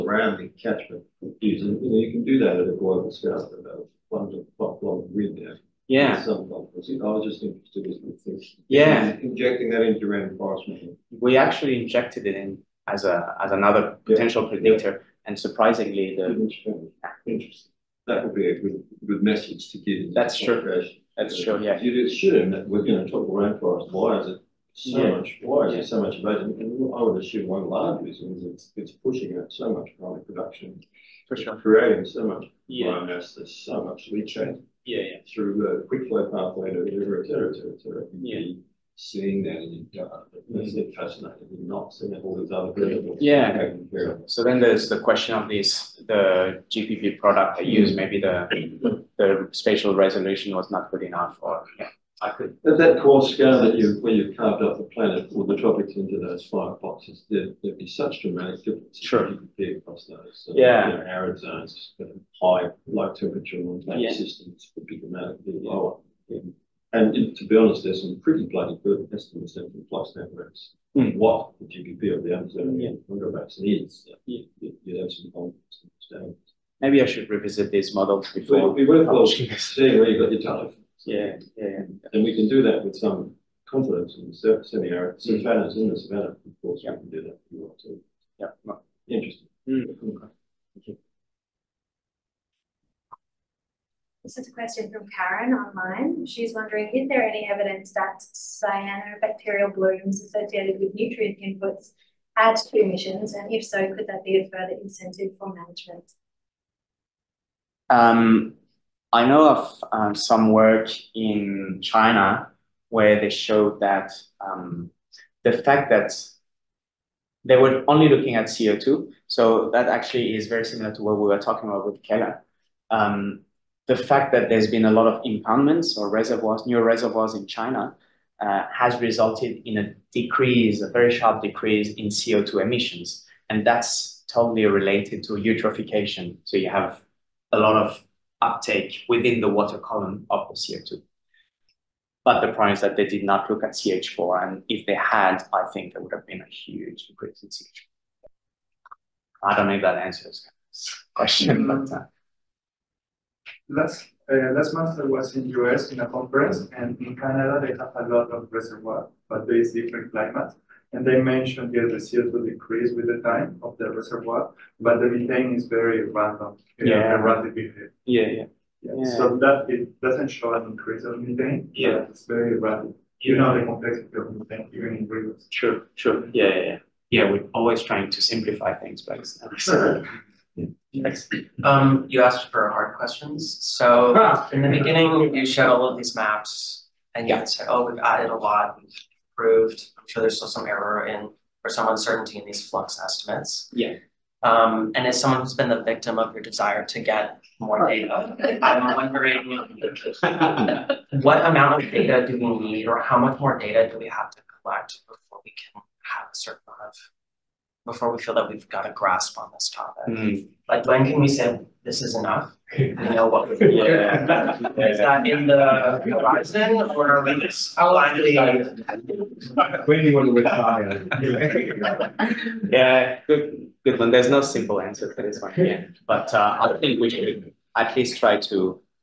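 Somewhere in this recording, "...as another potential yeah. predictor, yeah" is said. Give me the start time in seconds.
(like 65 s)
13 s.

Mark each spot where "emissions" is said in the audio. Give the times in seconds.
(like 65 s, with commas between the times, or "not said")
102 s, 132 s.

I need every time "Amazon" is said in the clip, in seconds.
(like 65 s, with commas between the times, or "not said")
72 s.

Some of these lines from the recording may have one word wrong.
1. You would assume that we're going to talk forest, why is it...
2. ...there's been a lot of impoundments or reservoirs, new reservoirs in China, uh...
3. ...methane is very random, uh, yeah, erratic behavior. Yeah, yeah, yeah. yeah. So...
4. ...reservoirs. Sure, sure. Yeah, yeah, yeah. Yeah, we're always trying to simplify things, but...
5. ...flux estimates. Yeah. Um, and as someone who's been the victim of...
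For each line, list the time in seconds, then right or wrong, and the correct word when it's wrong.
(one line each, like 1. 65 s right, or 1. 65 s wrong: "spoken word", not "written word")
1. 21 s wrong: "rainforest", not "forest"
2. 124 s right
3. 165 s right
4. 175 s wrong: "rivers", not "reservoirs"
5. 192 s right.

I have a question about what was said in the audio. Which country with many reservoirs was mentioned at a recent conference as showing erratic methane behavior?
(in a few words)
Canada.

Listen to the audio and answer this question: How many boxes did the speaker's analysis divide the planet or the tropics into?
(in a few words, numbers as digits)
5.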